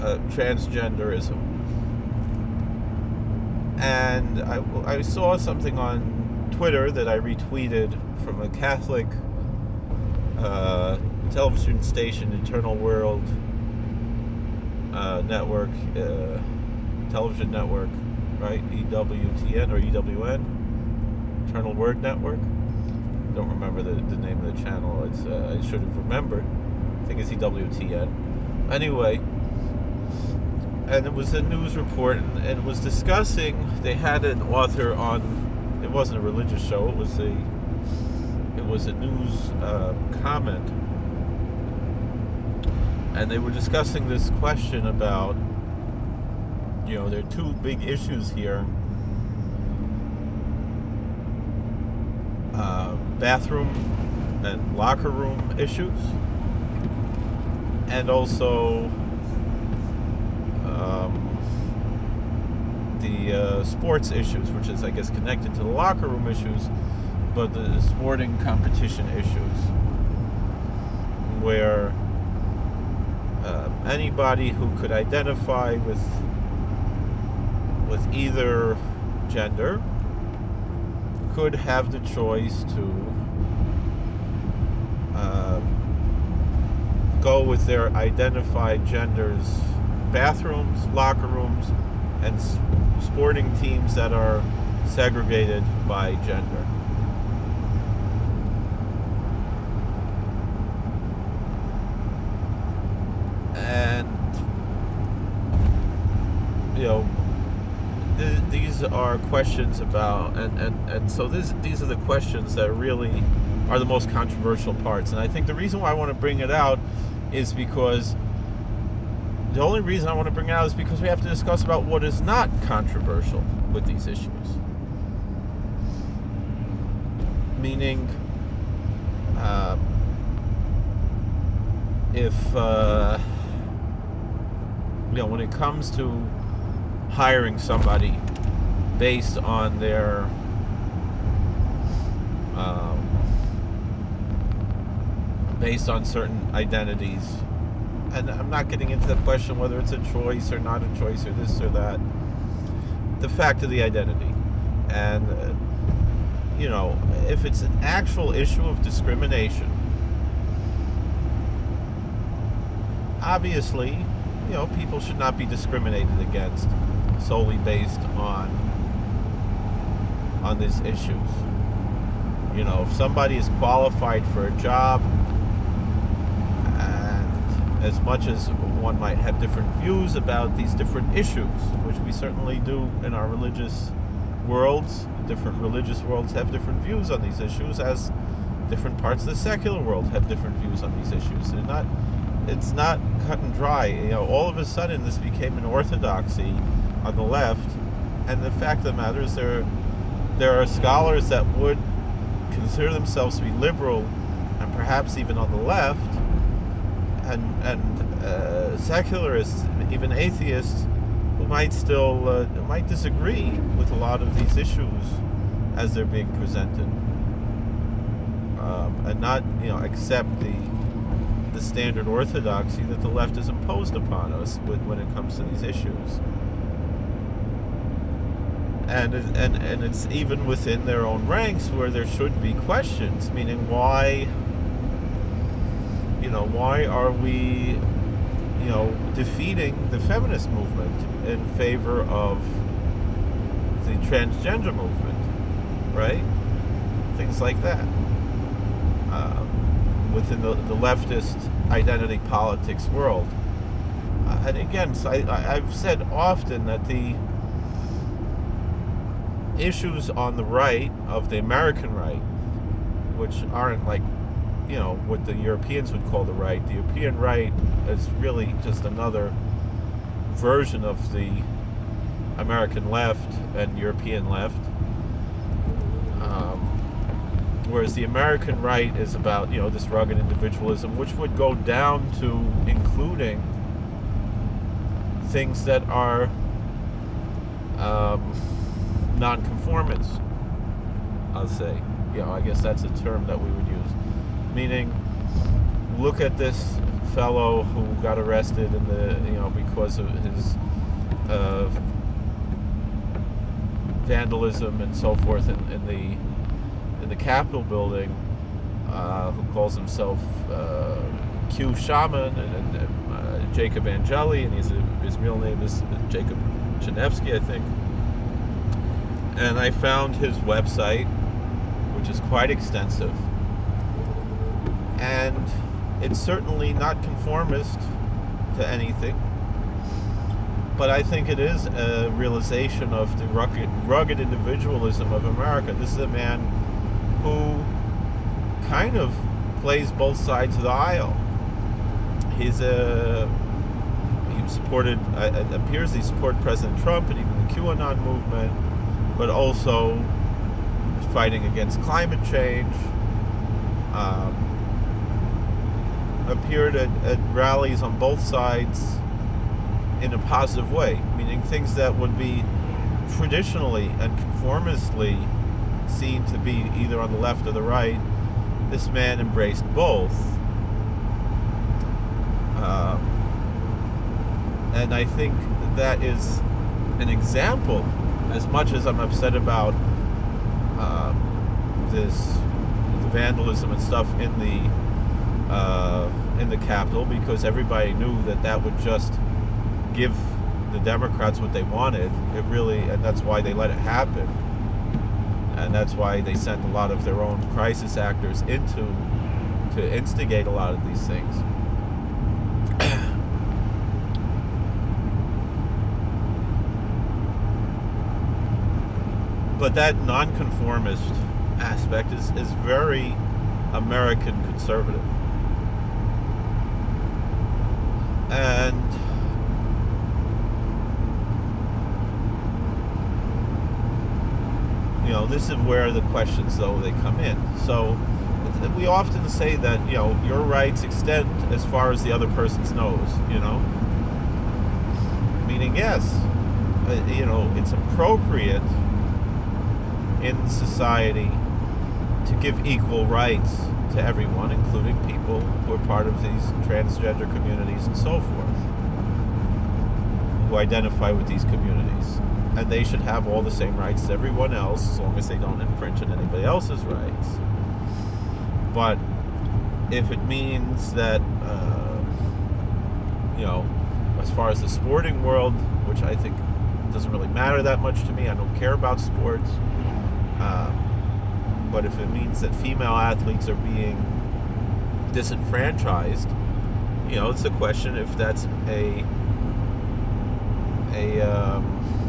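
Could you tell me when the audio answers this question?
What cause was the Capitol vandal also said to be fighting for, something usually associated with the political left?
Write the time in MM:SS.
05:51.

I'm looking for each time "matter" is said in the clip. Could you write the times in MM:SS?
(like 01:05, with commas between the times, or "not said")
03:18, 07:47.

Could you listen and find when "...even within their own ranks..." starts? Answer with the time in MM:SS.
03:50.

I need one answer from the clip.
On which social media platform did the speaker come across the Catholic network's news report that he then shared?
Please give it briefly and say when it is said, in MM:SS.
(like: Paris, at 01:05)
Twitter, at 00:06.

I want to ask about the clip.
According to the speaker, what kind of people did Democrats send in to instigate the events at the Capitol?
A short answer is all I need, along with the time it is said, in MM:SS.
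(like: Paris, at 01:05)
crisis actors, at 06:37.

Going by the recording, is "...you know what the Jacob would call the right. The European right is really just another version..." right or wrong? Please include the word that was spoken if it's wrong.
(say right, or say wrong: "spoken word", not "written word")
wrong: "Europeans", not "Jacob".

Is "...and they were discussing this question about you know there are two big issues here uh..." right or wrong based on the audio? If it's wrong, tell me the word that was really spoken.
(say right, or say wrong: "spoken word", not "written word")
right.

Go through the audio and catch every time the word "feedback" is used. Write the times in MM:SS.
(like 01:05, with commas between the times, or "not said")
not said.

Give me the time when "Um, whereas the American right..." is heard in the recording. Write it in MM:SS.
04:36.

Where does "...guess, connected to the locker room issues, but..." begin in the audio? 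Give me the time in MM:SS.
01:04.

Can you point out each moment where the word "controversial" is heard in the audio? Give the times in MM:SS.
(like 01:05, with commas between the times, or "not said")
01:54, 02:02.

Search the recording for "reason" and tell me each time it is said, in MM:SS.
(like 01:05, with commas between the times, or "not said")
01:55, 01:59.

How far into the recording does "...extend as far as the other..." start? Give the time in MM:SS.
07:10.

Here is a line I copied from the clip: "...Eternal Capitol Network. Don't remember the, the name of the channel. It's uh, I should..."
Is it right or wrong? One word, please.
wrong.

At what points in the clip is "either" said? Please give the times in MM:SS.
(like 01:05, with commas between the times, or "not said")
01:18, 06:06.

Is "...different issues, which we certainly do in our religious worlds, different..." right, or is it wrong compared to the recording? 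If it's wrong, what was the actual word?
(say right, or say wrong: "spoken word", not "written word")
right.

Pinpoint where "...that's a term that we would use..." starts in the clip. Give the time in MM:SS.
04:52.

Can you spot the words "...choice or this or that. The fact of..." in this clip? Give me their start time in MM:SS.
02:30.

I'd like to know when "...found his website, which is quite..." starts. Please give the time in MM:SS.
05:19.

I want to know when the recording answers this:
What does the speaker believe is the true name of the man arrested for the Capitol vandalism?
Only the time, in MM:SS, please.
05:16.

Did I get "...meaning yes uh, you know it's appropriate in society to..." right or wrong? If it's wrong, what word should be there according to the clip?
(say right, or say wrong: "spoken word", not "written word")
right.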